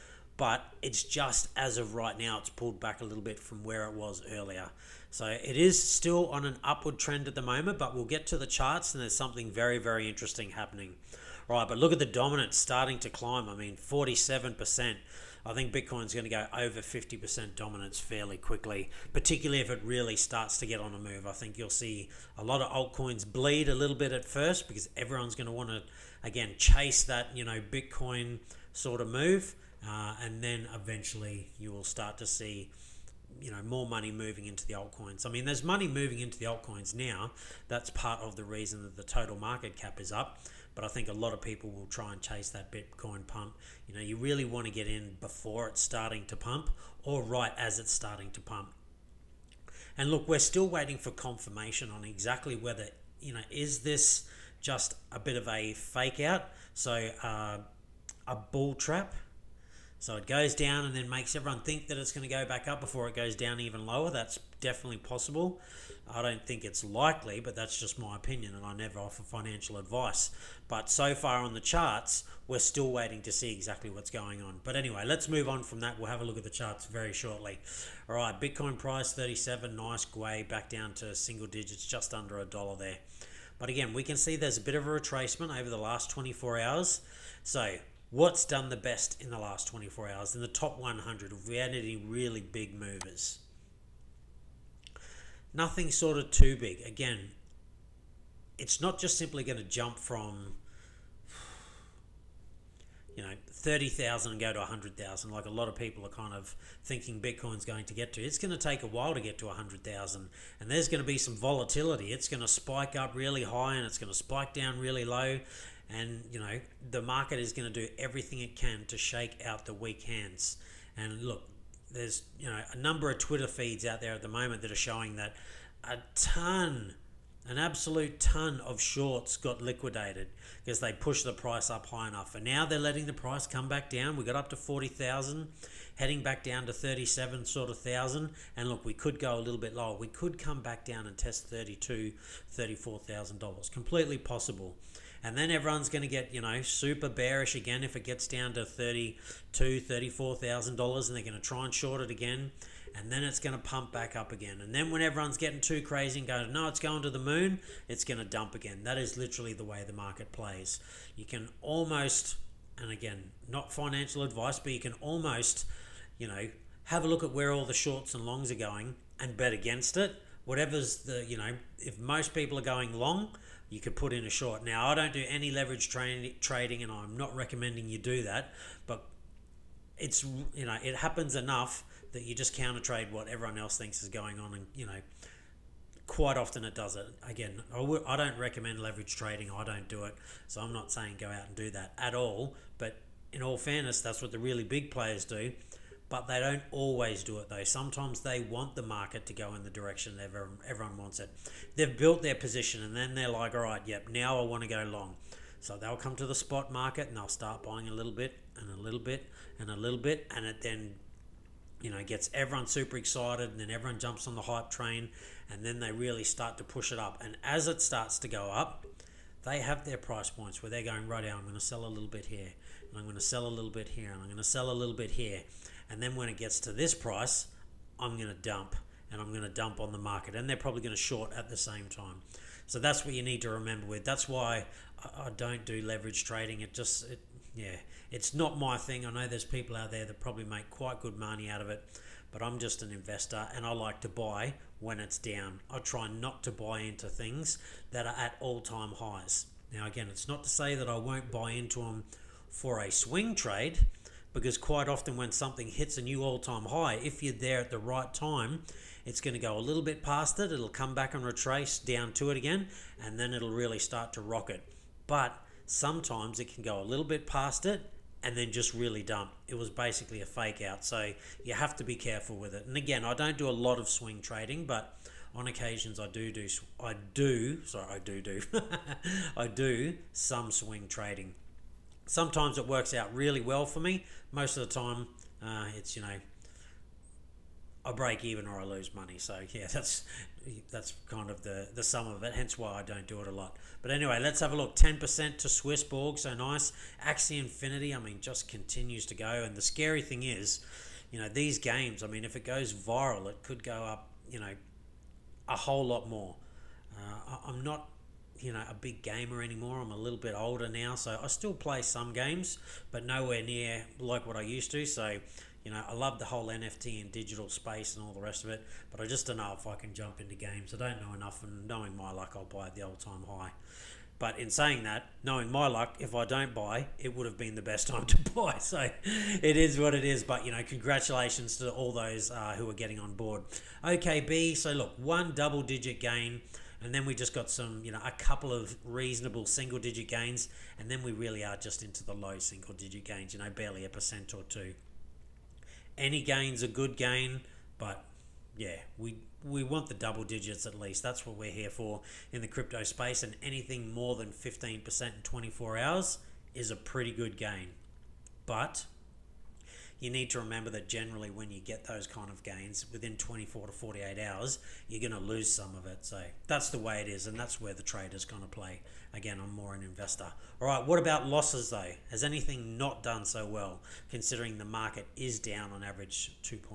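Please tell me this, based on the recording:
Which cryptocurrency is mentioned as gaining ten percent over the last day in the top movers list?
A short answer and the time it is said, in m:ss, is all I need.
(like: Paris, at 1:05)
Swissborg, at 4:55.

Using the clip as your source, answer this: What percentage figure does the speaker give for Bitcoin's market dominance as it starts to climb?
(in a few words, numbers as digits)
47%.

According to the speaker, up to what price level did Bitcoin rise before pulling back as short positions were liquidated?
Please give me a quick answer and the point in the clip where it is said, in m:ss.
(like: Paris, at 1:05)
$40,000, at 2:14.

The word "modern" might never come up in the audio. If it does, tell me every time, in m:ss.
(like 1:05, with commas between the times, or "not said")
not said.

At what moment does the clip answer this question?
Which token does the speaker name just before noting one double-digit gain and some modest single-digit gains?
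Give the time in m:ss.
5:33.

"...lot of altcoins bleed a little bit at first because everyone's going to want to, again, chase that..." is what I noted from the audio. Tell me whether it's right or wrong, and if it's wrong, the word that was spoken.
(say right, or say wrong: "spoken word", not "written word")
right.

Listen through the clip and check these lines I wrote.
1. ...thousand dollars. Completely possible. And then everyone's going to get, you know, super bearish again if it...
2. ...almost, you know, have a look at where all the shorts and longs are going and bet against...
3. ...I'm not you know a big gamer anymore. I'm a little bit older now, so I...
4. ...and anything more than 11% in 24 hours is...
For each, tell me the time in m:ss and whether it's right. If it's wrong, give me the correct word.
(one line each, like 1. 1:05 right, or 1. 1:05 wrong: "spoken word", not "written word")
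1. 2:22 right
2. 2:45 right
3. 5:07 right
4. 5:53 wrong: "15", not "11".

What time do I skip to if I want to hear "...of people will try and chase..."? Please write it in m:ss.
0:41.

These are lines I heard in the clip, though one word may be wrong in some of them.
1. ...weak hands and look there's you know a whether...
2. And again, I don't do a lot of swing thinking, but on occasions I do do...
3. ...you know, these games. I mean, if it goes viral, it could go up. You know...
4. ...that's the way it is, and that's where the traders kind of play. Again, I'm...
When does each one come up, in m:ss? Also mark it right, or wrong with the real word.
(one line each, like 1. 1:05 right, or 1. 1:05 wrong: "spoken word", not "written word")
1. 1:59 wrong: "number", not "whether"
2. 4:32 wrong: "trading", not "thinking"
3. 5:01 right
4. 6:06 right.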